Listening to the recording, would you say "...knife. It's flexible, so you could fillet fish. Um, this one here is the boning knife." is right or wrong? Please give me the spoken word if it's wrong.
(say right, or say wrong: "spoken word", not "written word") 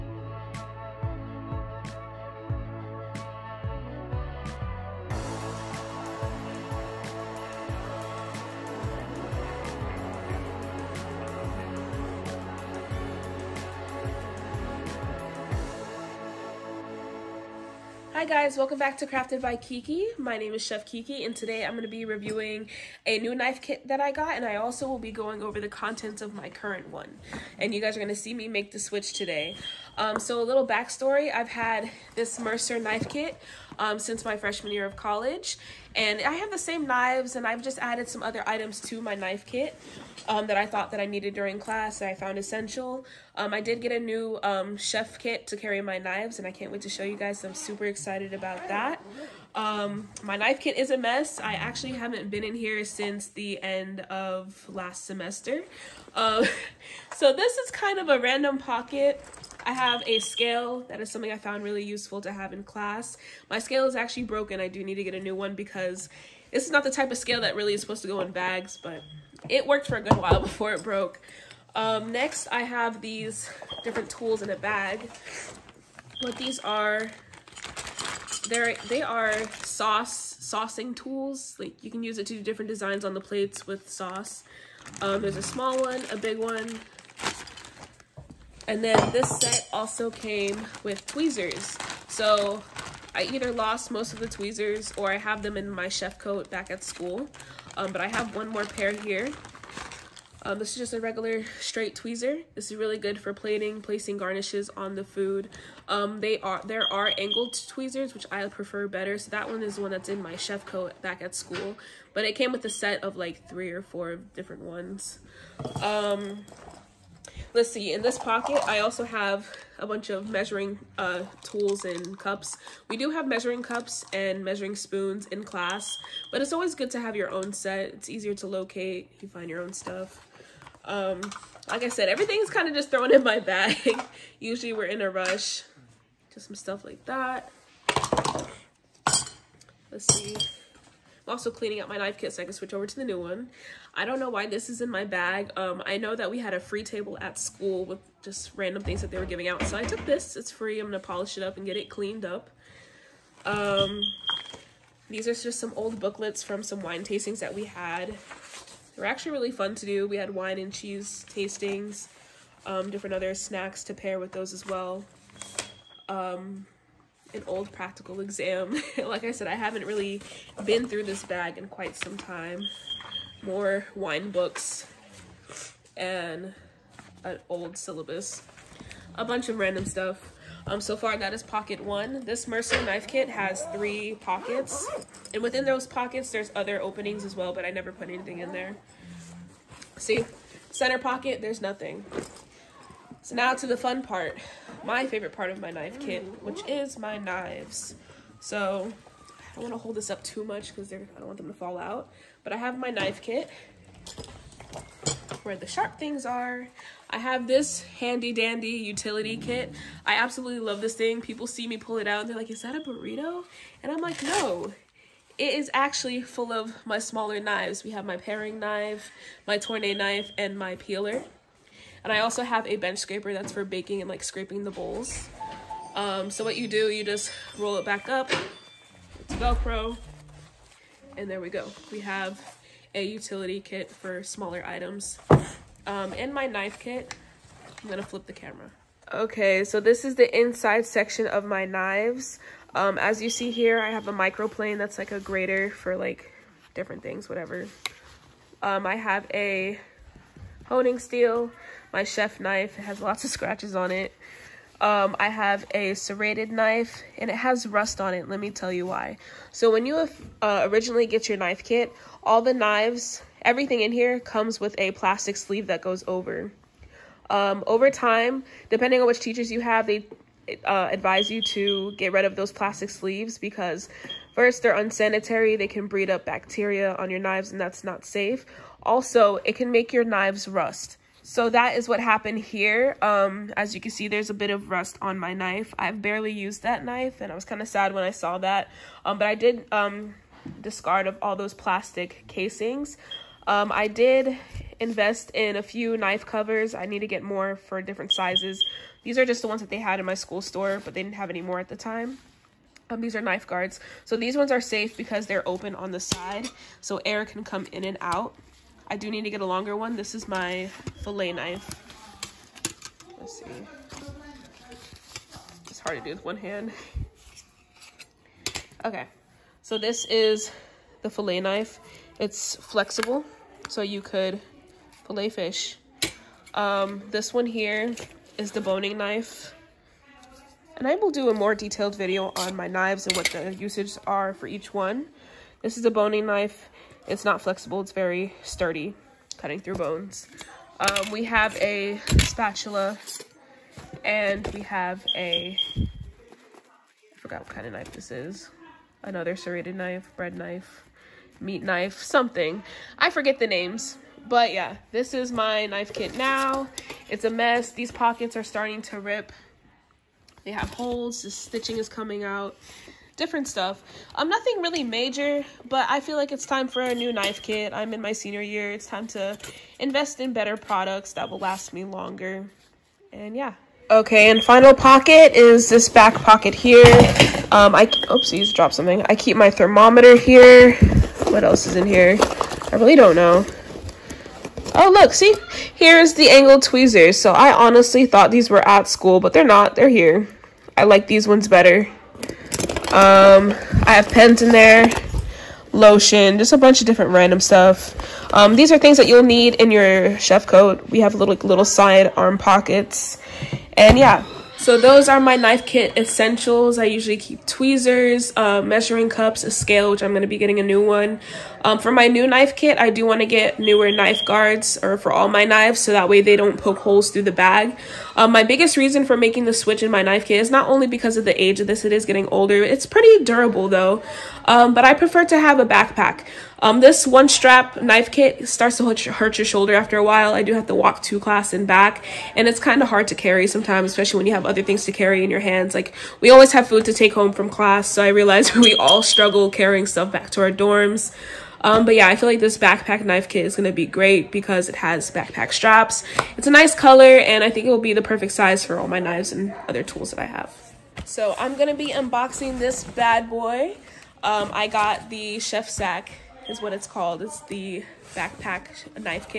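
right.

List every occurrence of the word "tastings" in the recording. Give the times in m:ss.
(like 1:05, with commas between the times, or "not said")
2:37, 2:41.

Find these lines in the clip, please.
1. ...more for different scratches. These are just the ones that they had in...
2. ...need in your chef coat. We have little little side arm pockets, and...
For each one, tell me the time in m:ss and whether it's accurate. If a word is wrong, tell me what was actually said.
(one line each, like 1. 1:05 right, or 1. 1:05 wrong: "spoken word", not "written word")
1. 4:57 wrong: "sizes", not "scratches"
2. 6:39 right.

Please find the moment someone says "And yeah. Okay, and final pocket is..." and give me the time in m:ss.
6:13.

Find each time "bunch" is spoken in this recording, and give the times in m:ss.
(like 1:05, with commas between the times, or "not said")
1:59, 2:59, 6:36.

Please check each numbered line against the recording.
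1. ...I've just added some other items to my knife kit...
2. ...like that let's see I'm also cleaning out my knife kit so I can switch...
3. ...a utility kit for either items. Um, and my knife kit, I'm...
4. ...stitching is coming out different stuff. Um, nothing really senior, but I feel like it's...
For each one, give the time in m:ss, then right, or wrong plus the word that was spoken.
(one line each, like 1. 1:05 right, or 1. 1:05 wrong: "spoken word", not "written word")
1. 0:37 right
2. 2:16 right
3. 3:52 wrong: "smaller", not "either"
4. 6:01 wrong: "major", not "senior".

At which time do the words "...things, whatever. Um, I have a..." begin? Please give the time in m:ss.
4:07.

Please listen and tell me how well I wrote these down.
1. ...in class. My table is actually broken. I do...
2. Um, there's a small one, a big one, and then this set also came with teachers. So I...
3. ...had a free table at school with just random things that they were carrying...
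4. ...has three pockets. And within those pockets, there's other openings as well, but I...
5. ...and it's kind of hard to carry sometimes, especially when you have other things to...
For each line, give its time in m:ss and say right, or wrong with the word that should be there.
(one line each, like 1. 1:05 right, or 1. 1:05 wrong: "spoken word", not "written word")
1. 1:02 wrong: "scale", not "table"
2. 1:25 wrong: "tweezers", not "teachers"
3. 2:26 wrong: "giving", not "carrying"
4. 3:03 right
5. 7:12 right.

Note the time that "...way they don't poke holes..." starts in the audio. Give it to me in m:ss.
6:56.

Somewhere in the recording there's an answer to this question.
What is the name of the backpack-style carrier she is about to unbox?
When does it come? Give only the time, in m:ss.
7:35.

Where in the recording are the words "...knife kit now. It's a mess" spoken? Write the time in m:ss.
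5:55.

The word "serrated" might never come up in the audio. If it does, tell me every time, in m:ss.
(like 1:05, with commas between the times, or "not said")
4:15, 5:49.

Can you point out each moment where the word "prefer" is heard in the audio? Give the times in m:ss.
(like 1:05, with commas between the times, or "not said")
1:48, 7:04.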